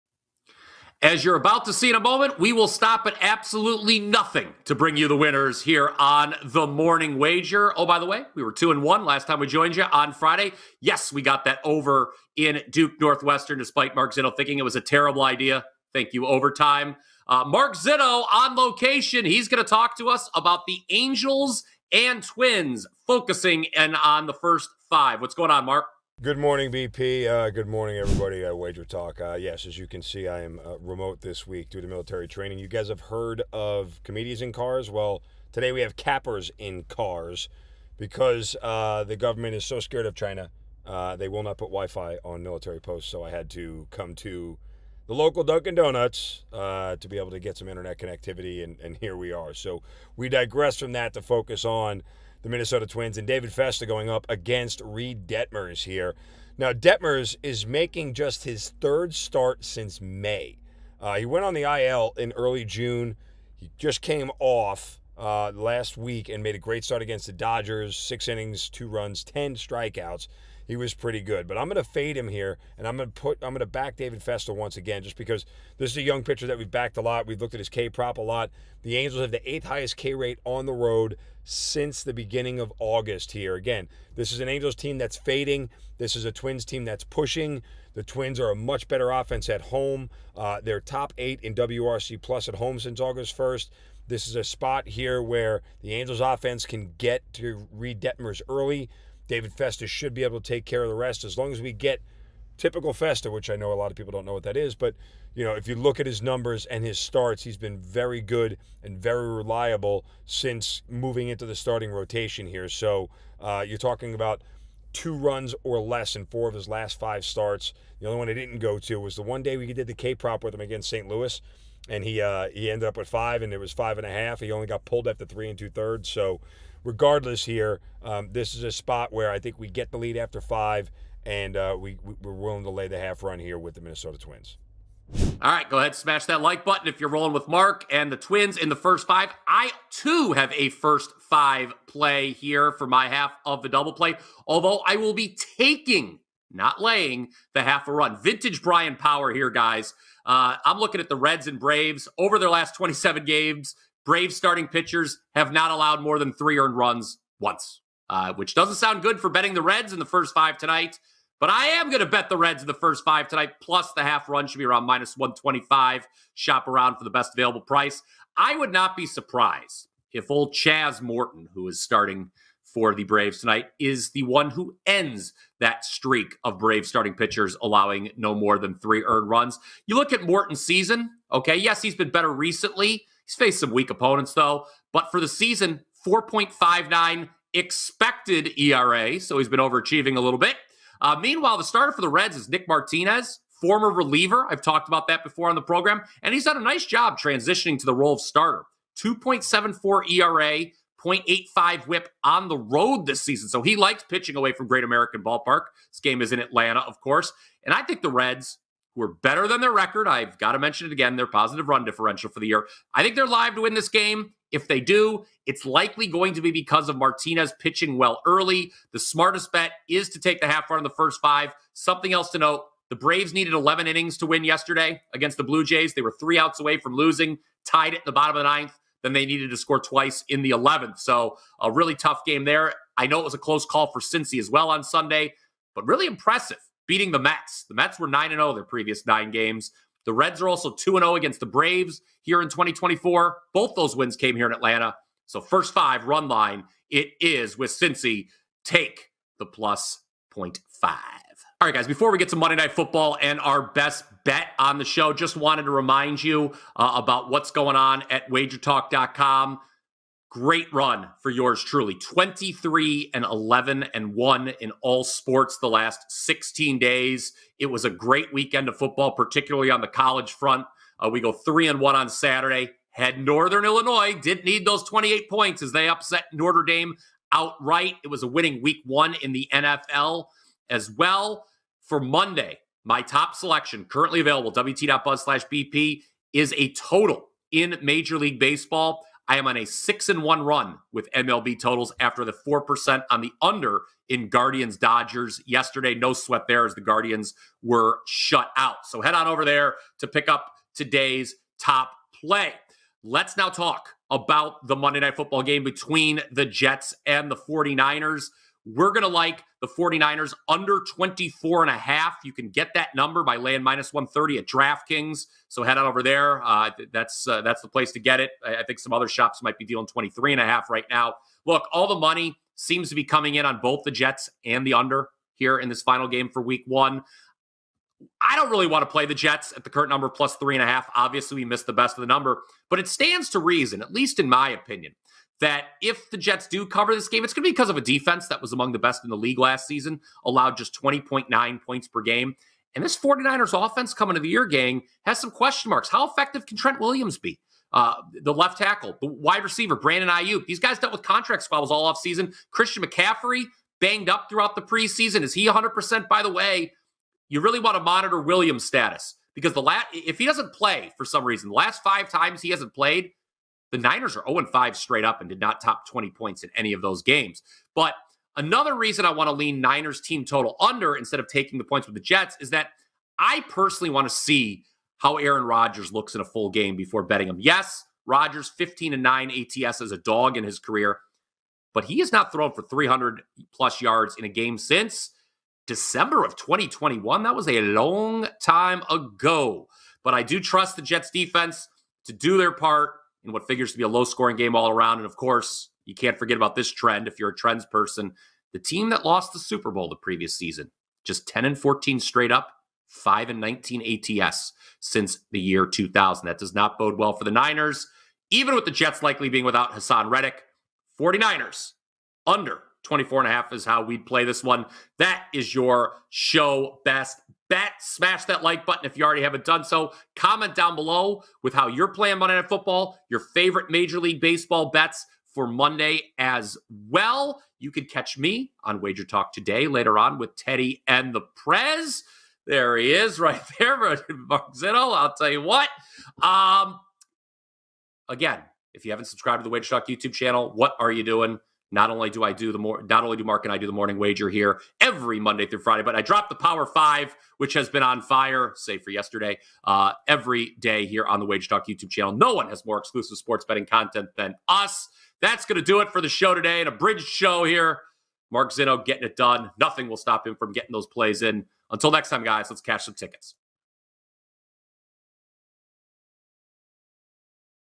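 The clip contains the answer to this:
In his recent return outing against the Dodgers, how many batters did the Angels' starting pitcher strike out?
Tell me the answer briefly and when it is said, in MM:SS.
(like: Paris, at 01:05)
10, at 01:09.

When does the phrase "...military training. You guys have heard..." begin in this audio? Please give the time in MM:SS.
00:31.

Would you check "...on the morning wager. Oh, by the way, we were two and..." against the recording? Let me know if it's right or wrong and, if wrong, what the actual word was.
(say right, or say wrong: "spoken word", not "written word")
right.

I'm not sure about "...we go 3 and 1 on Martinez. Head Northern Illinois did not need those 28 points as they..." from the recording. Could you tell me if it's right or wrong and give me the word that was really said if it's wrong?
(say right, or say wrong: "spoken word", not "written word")
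wrong: "Saturday", not "Martinez".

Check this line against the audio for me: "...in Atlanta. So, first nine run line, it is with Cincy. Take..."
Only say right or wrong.
wrong.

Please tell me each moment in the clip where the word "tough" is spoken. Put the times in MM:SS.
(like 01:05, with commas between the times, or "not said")
03:51.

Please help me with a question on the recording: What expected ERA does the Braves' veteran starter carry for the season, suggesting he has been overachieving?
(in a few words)
4.59.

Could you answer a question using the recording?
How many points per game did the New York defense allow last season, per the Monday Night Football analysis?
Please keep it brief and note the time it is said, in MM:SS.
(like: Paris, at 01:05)
20.9, at 05:40.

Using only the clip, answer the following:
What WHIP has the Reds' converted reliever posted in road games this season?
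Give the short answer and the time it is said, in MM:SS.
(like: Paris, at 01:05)
0.85, at 03:21.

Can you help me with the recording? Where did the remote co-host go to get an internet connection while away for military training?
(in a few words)
Dunkin' Donuts.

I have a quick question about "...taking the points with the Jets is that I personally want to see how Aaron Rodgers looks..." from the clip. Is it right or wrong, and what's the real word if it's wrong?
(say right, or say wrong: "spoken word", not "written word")
right.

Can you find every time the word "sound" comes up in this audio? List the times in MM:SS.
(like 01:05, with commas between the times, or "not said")
02:38.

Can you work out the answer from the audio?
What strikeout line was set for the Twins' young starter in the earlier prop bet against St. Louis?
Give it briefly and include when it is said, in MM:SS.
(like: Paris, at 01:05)
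5.5, at 02:03.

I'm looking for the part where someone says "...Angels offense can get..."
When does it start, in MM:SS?
01:35.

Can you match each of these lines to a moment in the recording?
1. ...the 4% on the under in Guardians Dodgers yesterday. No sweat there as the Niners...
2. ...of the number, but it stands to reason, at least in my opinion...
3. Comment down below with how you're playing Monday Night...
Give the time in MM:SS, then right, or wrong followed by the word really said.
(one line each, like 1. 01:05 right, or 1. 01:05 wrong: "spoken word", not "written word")
1. 04:52 wrong: "Guardians", not "Niners"
2. 05:31 right
3. 07:00 right.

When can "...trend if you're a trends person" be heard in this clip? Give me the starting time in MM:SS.
06:36.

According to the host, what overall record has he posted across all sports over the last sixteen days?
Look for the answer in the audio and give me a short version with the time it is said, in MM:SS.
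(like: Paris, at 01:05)
23-11-1, at 04:21.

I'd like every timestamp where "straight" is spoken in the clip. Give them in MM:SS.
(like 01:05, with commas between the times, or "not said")
06:04, 06:41.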